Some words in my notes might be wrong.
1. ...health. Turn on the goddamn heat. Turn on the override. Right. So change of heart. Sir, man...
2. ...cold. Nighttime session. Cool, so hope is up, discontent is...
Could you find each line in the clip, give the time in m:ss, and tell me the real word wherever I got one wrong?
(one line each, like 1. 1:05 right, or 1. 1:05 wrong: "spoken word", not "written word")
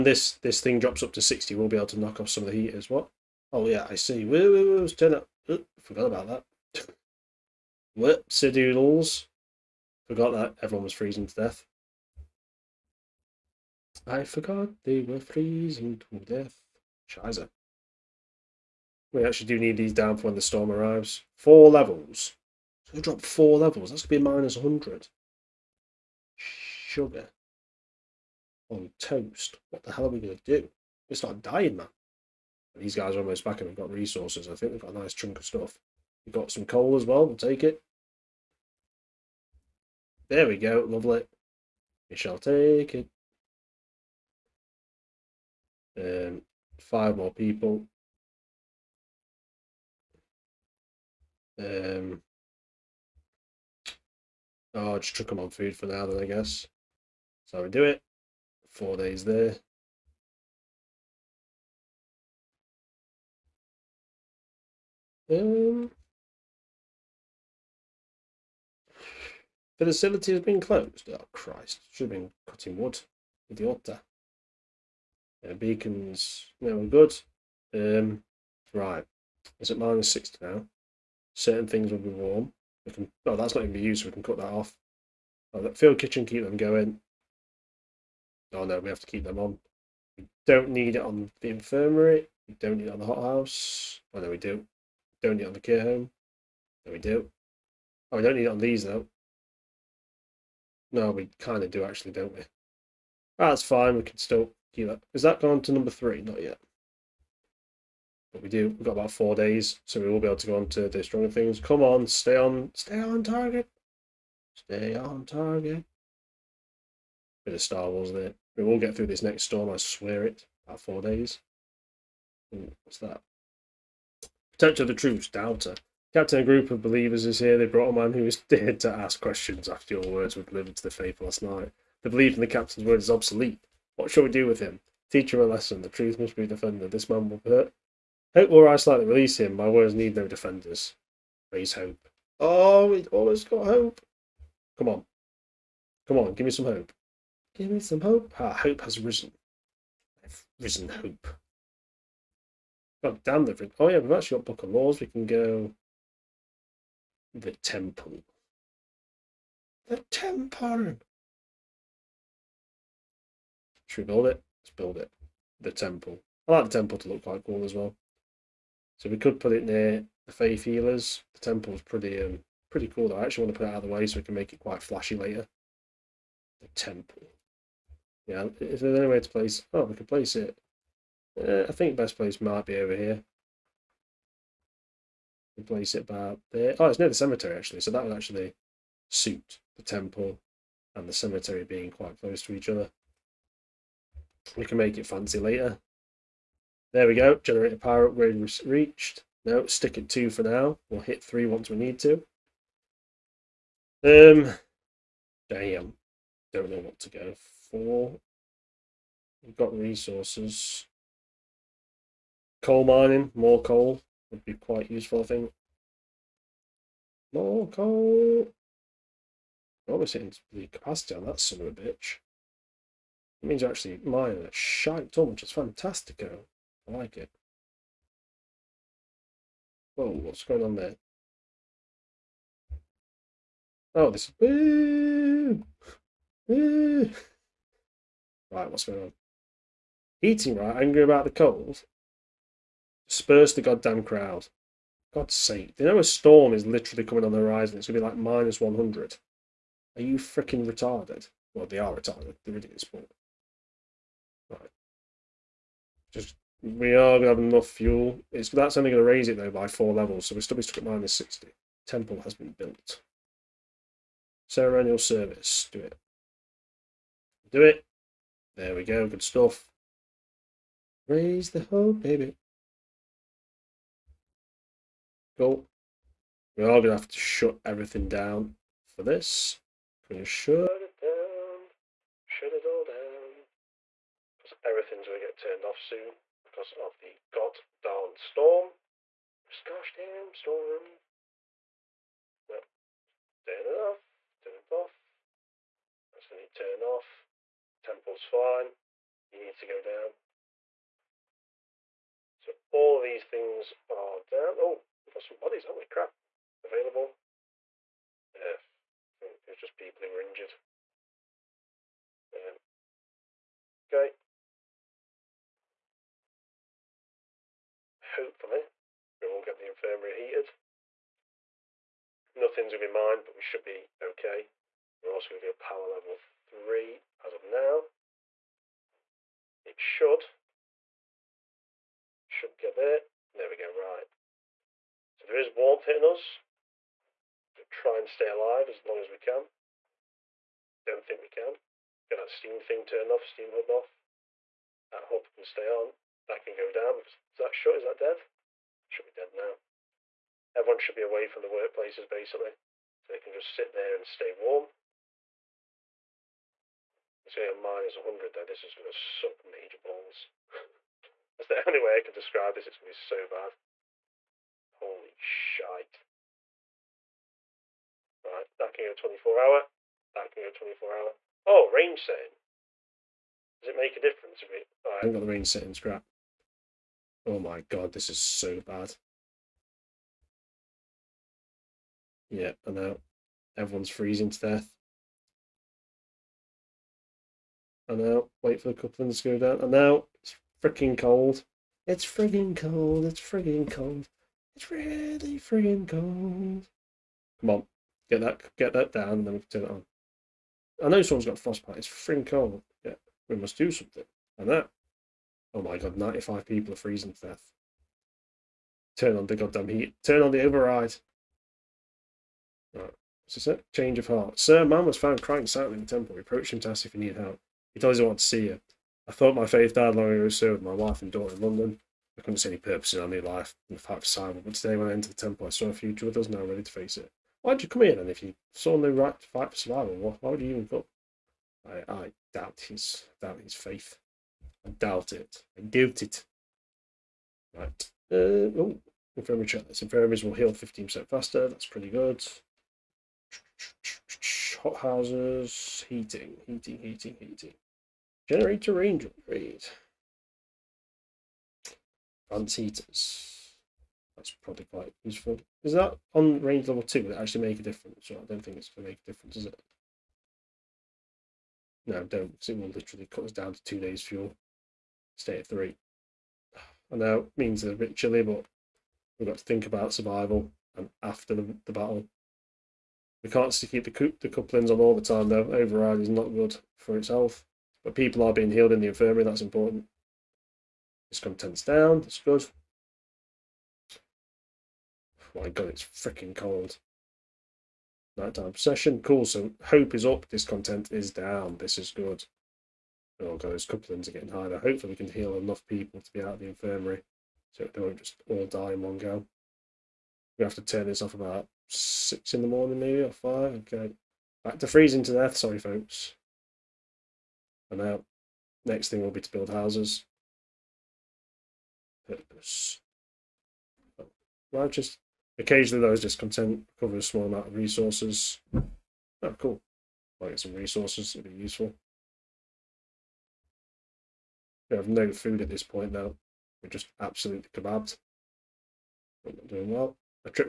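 1. 6:47 wrong: "death", not "health"
2. 8:06 right.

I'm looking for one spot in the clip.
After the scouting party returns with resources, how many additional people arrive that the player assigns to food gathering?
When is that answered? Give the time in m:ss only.
0:46.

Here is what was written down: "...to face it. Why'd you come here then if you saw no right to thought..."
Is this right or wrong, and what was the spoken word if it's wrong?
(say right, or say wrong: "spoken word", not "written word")
wrong: "fight", not "thought".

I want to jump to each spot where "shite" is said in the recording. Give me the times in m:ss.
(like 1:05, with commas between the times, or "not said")
3:44, 6:05.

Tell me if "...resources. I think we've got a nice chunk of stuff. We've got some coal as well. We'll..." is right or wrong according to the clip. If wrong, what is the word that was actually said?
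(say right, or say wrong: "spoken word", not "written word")
right.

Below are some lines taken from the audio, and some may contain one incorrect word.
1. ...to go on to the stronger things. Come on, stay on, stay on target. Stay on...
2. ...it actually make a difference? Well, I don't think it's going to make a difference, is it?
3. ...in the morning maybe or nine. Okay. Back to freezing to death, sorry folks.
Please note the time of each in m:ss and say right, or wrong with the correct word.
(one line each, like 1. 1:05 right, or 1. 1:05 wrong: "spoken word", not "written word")
1. 1:50 right
2. 7:37 right
3. 8:22 wrong: "five", not "nine".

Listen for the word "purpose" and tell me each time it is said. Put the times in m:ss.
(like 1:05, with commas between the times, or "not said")
7:02, 8:32.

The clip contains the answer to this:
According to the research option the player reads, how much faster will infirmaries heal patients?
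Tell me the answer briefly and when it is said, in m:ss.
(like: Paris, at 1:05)
15%, at 7:20.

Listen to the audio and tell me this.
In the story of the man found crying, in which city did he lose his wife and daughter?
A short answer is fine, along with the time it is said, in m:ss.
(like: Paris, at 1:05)
London, at 7:01.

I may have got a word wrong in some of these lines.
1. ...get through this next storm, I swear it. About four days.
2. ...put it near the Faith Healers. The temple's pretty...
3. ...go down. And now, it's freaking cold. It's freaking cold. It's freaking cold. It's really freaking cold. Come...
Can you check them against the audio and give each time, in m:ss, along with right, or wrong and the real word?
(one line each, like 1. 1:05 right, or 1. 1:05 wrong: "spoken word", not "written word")
1. 1:58 right
2. 2:49 right
3. 6:29 right.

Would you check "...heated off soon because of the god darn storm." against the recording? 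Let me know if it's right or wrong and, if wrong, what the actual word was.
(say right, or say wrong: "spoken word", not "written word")
wrong: "turned", not "heated".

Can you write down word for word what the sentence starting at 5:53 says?
So they can just sit there and stay warm.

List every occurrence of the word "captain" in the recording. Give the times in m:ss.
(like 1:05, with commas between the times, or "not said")
2:06, 2:12.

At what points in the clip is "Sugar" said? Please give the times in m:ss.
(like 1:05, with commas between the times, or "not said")
0:26.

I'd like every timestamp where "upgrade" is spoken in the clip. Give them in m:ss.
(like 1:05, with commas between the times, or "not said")
3:18, 7:29.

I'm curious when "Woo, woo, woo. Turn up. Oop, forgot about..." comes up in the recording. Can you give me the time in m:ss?
0:04.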